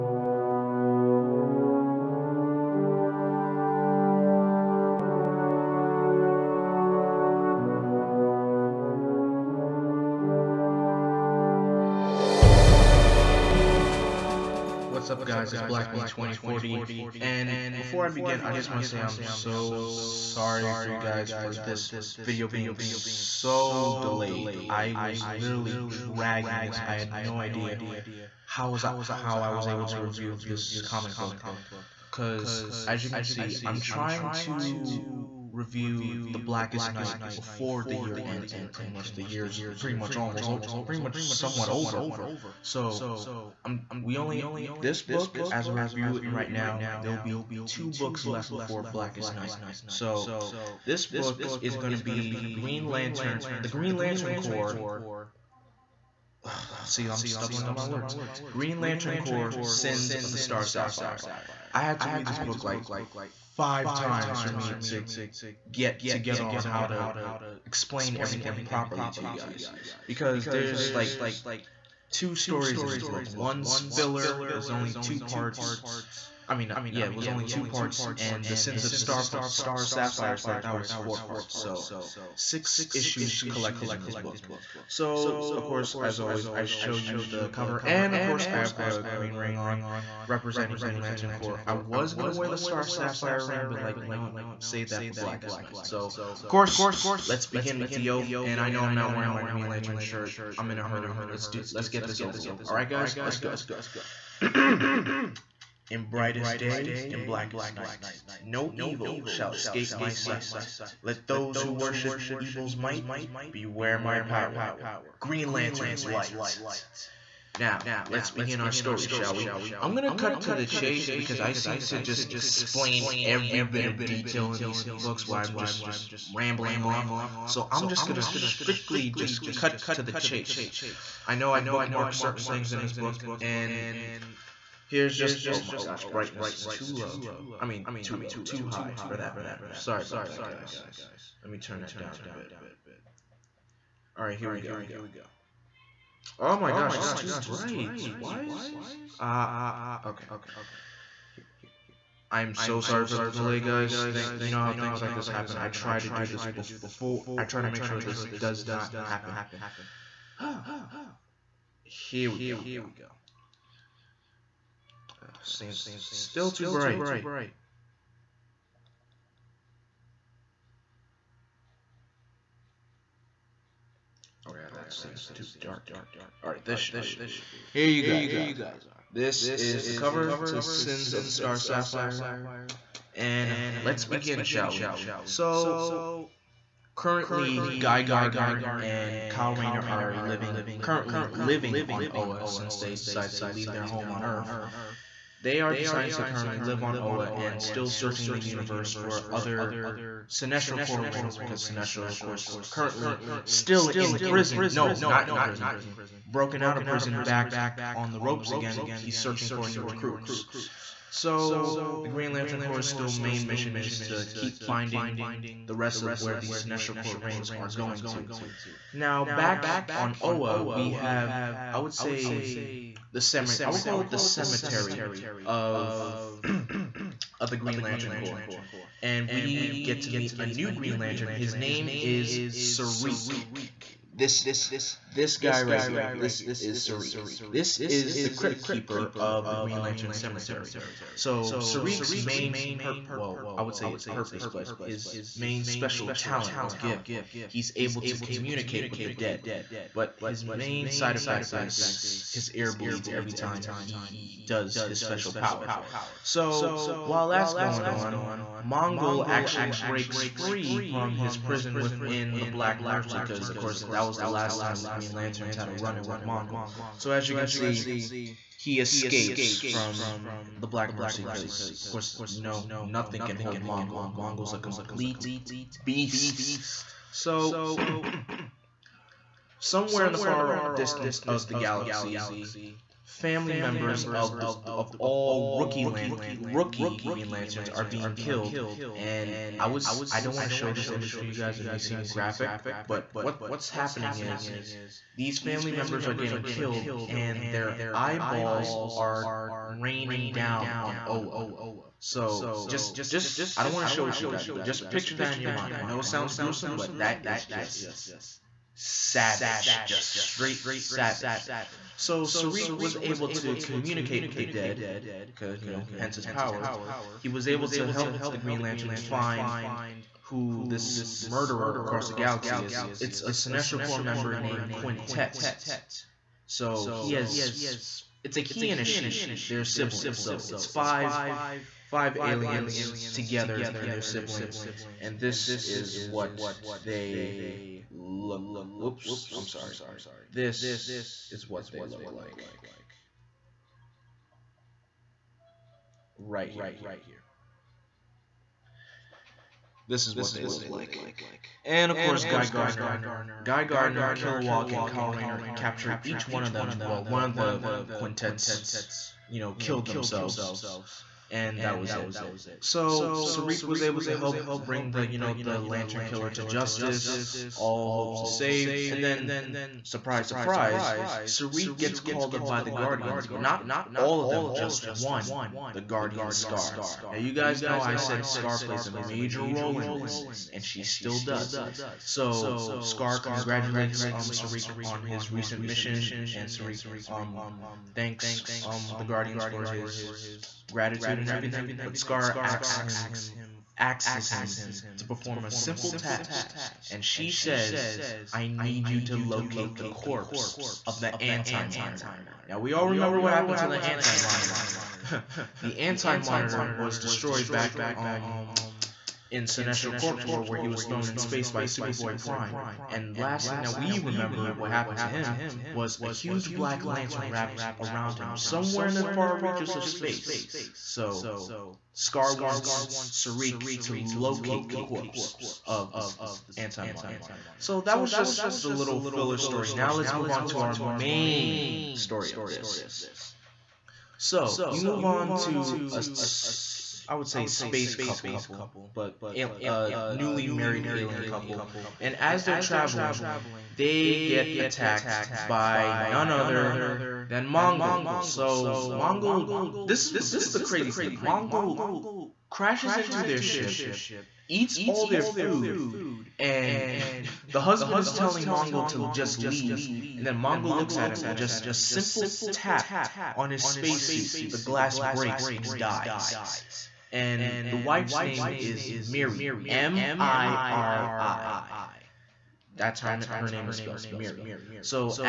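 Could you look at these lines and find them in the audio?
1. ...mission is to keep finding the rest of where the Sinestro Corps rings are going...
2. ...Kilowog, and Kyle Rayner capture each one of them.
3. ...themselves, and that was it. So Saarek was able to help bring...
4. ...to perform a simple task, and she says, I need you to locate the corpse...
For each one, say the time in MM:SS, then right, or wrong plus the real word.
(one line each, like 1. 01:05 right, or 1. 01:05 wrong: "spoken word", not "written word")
1. 03:33 right
2. 05:54 right
3. 05:59 right
4. 06:34 right.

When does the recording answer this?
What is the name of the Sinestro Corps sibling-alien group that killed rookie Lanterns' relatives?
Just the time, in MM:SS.
05:24.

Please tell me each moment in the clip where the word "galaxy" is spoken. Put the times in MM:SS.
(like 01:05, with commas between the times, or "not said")
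04:41, 05:22.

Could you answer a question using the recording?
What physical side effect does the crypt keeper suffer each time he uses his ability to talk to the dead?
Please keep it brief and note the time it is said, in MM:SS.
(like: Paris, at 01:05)
His ear bleeds, at 04:12.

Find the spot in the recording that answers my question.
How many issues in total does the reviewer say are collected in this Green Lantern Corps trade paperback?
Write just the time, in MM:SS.
01:22.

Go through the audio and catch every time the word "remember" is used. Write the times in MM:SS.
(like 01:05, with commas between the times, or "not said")
06:42, 06:53.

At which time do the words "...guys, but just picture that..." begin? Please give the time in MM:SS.
05:04.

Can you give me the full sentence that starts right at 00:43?
I'm, we only this book, as I review it right now, there will be two books left before Blackest Night.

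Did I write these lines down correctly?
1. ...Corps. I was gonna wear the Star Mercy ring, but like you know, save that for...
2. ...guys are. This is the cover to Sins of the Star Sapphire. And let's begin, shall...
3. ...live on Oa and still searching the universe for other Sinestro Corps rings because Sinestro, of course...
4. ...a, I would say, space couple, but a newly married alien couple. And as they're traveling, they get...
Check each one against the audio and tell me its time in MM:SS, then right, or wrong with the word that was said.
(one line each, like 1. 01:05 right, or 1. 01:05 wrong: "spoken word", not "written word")
1. 01:31 wrong: "Sapphire", not "Mercy"
2. 02:58 right
3. 03:16 right
4. 07:15 right.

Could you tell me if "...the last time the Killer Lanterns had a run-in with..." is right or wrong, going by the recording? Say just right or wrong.
wrong.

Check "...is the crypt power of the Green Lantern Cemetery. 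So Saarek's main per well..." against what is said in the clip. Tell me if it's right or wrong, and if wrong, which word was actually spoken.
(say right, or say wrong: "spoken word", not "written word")
wrong: "keeper", not "power".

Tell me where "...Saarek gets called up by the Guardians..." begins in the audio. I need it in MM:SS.
06:11.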